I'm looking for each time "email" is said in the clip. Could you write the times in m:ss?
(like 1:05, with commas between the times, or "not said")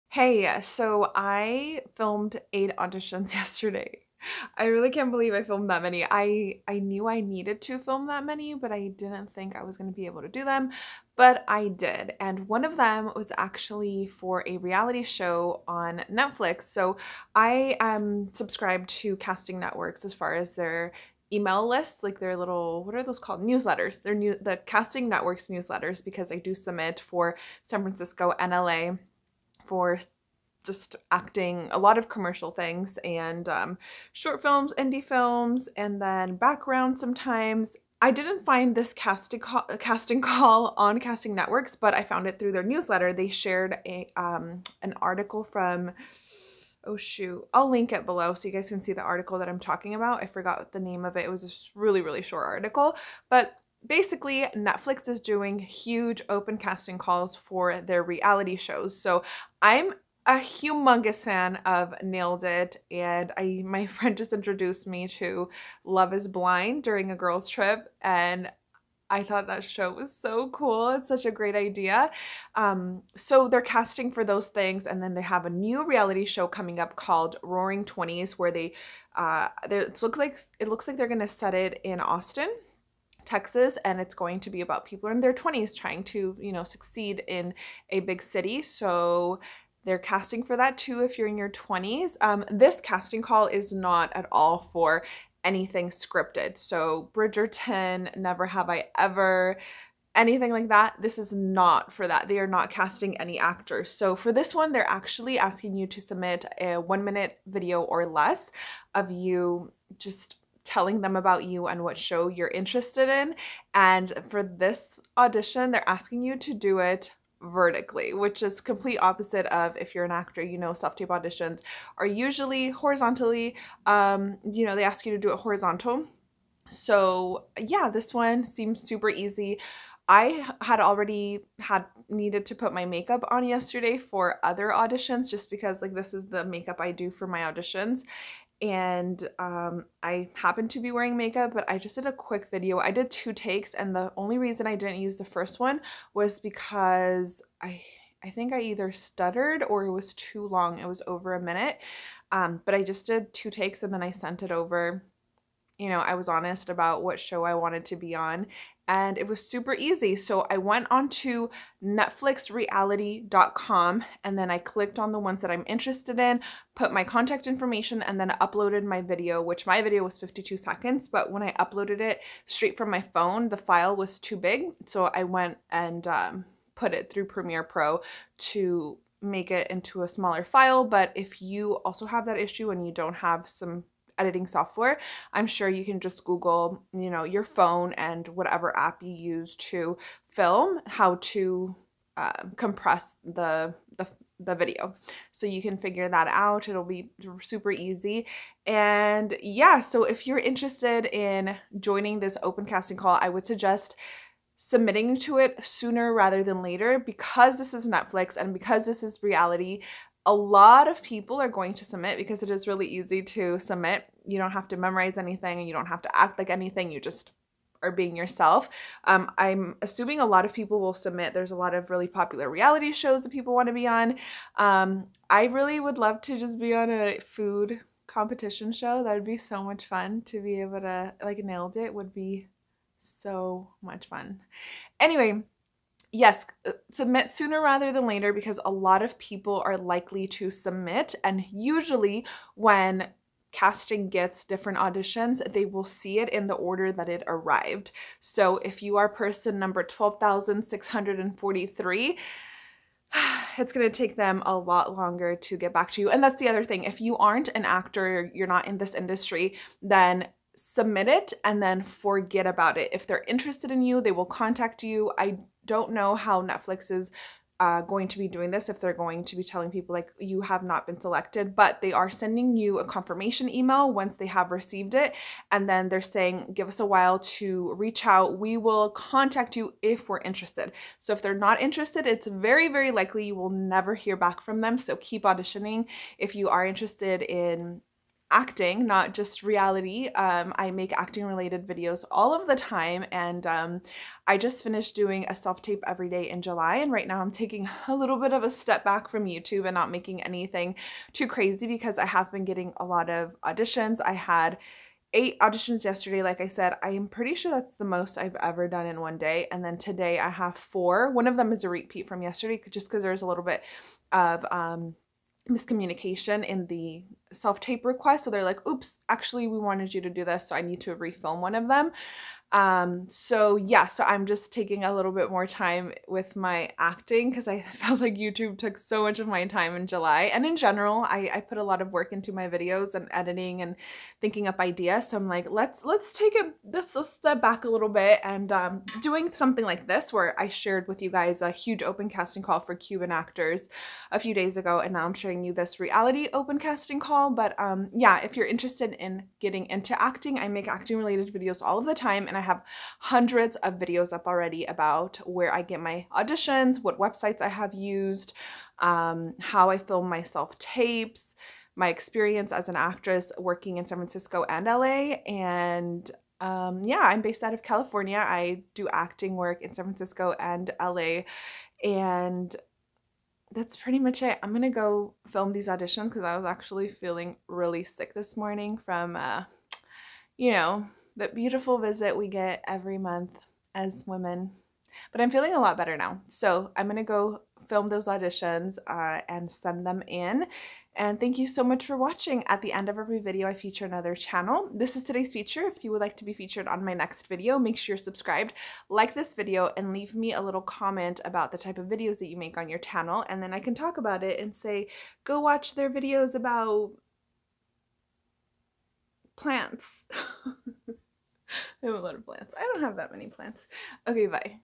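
0:21, 4:33.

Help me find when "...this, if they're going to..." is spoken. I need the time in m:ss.
4:28.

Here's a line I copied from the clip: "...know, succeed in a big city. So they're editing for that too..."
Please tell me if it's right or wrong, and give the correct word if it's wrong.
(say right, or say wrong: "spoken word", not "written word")
wrong: "casting", not "editing".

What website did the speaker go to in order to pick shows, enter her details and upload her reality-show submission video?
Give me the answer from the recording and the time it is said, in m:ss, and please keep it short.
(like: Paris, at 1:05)
netflixreality.com, at 2:41.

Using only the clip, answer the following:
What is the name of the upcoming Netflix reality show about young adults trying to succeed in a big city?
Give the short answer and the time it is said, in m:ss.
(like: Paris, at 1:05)
Roaring Twenties, at 1:17.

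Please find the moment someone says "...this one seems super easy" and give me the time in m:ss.
2:07.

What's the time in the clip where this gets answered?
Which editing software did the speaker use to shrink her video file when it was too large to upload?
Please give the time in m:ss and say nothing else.
2:57.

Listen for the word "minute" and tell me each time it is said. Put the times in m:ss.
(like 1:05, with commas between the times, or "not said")
1:47, 2:31.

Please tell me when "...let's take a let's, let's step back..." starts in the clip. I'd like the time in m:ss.
5:35.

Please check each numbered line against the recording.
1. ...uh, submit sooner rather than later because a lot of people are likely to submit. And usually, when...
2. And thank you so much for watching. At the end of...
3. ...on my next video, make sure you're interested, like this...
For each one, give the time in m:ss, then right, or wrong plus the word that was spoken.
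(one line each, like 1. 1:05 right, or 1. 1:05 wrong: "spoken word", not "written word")
1. 3:56 right
2. 6:30 right
3. 6:36 wrong: "subscribed", not "interested".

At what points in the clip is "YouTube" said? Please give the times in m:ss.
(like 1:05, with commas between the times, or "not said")
4:59, 5:28.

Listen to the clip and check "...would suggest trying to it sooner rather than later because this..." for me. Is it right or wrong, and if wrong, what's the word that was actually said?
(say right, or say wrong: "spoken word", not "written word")
wrong: "submitting", not "trying".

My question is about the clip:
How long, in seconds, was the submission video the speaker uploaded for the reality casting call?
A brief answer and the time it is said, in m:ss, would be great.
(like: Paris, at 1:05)
52, at 2:50.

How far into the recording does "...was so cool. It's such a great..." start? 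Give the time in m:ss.
1:09.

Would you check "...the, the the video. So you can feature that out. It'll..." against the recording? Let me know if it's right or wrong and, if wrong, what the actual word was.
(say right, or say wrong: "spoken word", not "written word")
wrong: "figure", not "feature".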